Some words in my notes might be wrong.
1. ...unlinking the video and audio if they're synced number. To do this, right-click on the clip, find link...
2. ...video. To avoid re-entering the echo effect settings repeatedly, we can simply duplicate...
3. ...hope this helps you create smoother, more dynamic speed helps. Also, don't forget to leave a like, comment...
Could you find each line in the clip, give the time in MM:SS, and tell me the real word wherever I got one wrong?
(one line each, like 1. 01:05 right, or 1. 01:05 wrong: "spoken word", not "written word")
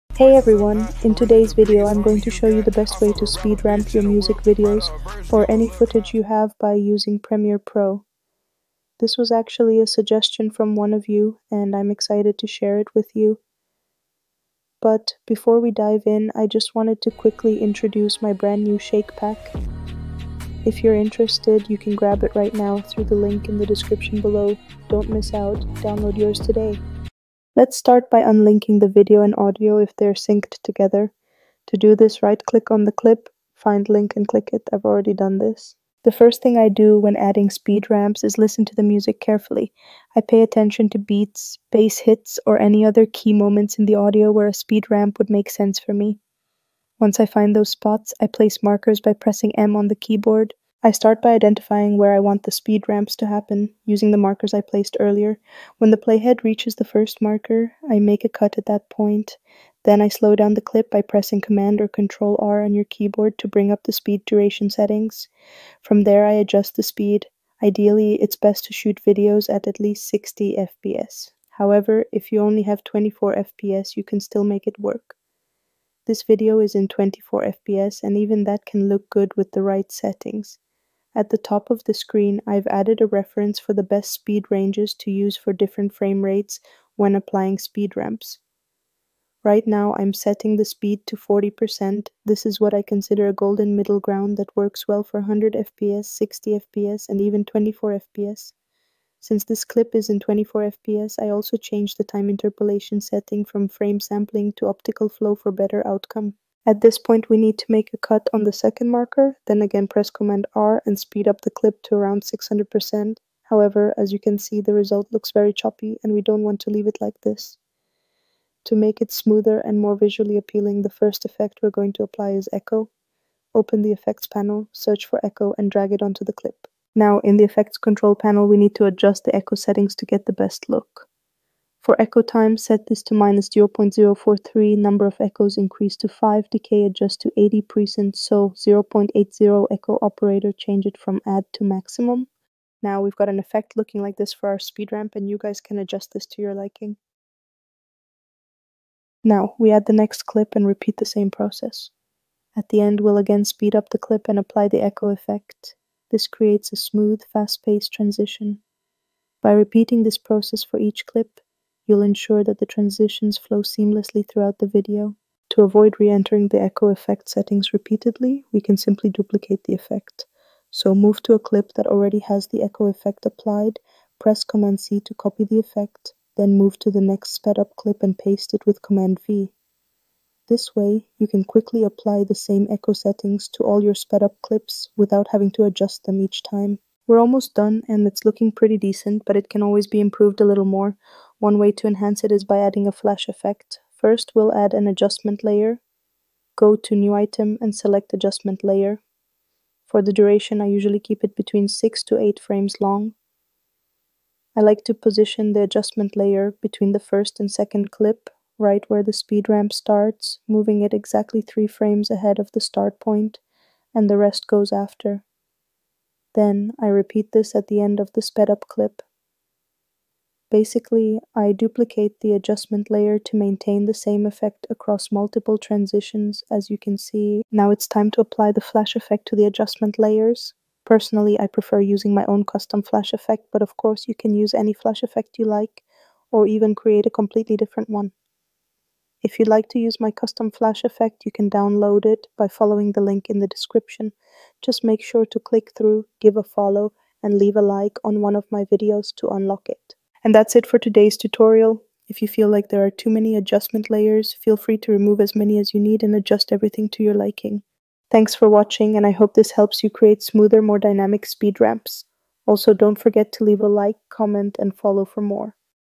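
1. 00:28 wrong: "together", not "number"
2. 02:44 right
3. 04:19 wrong: "ramps", not "helps".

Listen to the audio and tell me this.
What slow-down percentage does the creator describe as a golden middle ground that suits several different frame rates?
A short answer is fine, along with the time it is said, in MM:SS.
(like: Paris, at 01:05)
40%, at 01:31.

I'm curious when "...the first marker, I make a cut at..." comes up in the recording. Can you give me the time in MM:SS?
00:56.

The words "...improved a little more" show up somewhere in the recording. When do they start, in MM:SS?
03:09.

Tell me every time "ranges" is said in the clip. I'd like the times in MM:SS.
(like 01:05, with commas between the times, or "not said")
01:24.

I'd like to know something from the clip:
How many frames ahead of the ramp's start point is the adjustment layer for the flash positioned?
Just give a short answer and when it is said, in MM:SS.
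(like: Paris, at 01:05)
3, at 03:31.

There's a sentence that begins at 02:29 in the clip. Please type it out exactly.
Now, we add the next clip and repeat the same process.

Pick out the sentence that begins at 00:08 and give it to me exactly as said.
This was actually a suggestion from one of you and I'm excited to share it with you.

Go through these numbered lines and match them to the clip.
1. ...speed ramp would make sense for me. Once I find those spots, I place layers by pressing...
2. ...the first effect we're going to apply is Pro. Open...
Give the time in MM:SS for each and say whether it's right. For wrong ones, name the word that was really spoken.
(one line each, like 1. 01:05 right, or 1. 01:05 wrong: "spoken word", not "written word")
1. 00:44 wrong: "markers", not "layers"
2. 02:00 wrong: "Echo", not "Pro".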